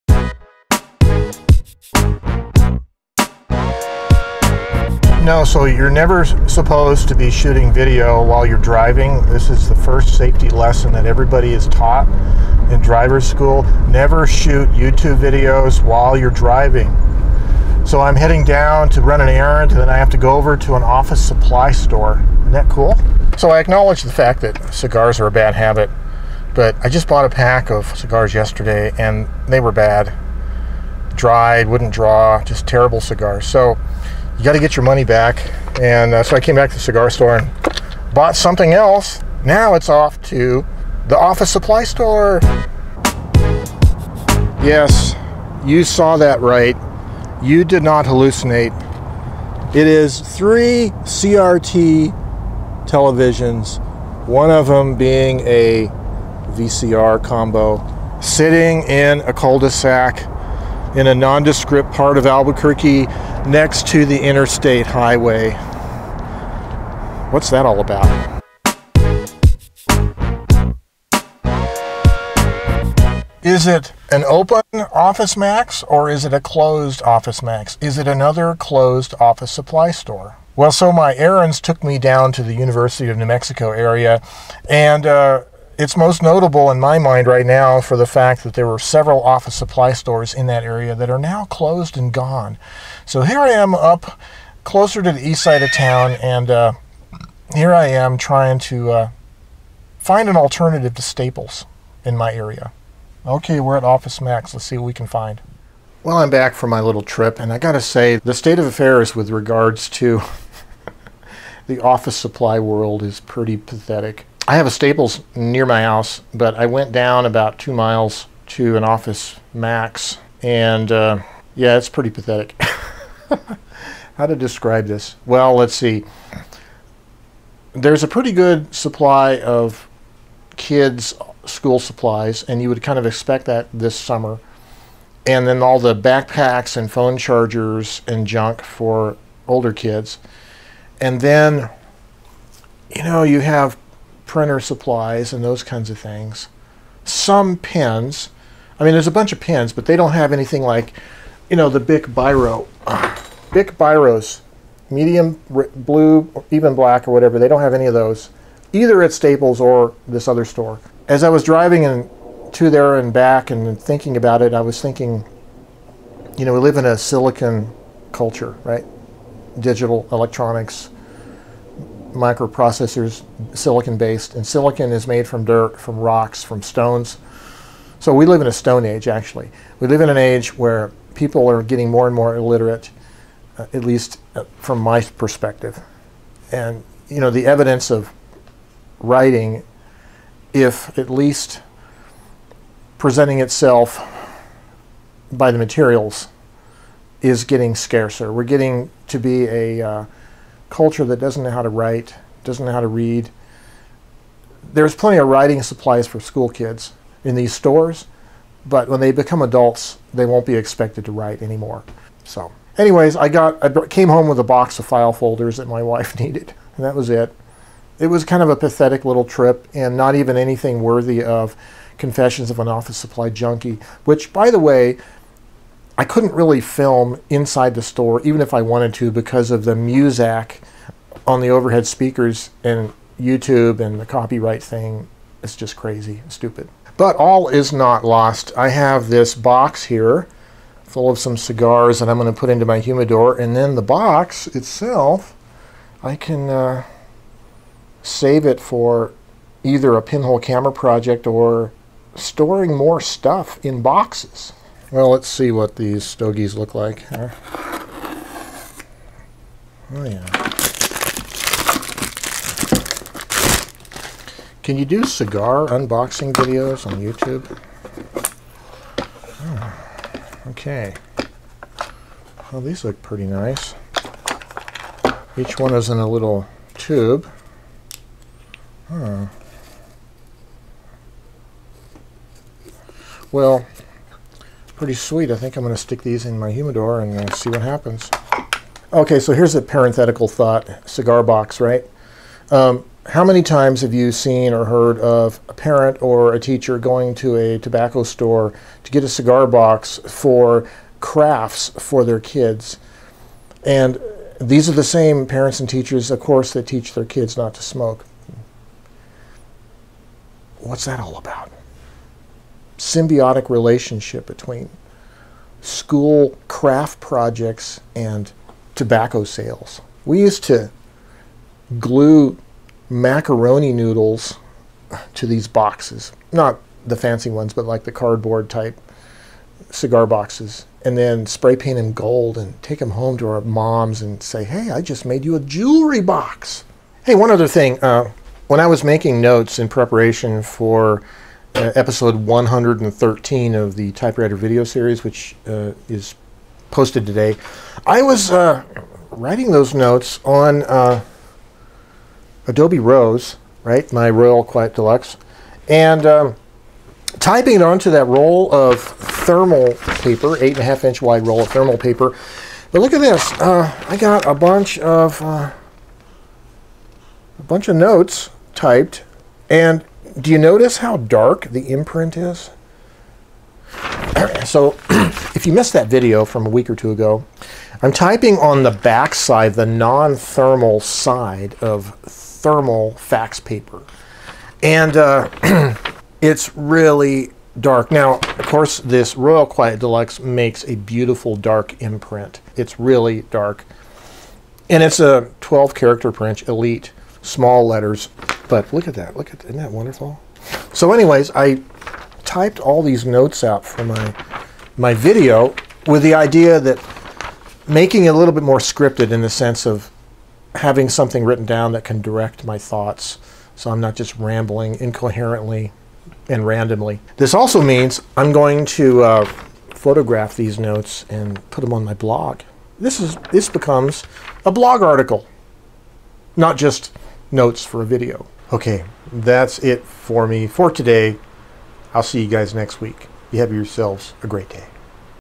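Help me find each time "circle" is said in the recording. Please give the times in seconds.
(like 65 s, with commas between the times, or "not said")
not said.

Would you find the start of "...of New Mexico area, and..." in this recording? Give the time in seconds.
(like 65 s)
83 s.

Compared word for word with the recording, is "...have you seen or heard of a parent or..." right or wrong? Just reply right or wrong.
right.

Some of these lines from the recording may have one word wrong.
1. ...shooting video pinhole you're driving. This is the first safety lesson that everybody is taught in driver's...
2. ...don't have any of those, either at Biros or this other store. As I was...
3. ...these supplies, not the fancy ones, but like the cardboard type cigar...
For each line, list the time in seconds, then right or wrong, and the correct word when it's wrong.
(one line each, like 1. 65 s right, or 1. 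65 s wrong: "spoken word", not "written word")
1. 7 s wrong: "while", not "pinhole"
2. 157 s wrong: "Staples", not "Biros"
3. 325 s wrong: "boxes", not "supplies".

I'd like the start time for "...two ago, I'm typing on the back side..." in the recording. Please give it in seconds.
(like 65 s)
376 s.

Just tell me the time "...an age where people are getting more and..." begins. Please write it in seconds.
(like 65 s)
180 s.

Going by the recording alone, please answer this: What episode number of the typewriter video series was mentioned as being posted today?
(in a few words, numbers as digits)
113.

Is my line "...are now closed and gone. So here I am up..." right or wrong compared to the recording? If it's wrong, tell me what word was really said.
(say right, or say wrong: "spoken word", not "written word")
right.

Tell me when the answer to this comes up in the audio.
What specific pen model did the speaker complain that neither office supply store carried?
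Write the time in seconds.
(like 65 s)
151 s.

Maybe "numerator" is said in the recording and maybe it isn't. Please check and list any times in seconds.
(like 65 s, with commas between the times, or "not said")
not said.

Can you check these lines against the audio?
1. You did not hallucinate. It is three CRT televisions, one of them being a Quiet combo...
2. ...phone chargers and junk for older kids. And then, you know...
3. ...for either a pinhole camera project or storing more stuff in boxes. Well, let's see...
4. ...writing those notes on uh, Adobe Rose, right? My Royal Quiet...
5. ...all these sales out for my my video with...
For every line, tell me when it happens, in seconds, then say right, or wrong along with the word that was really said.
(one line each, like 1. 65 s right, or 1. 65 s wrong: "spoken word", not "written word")
1. 47 s wrong: "VCR", not "Quiet"
2. 136 s right
3. 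248 s right
4. 349 s right
5. 402 s wrong: "notes", not "sales".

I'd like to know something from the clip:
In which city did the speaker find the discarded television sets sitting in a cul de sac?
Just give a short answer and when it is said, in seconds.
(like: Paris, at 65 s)
Albuquerque, at 62 s.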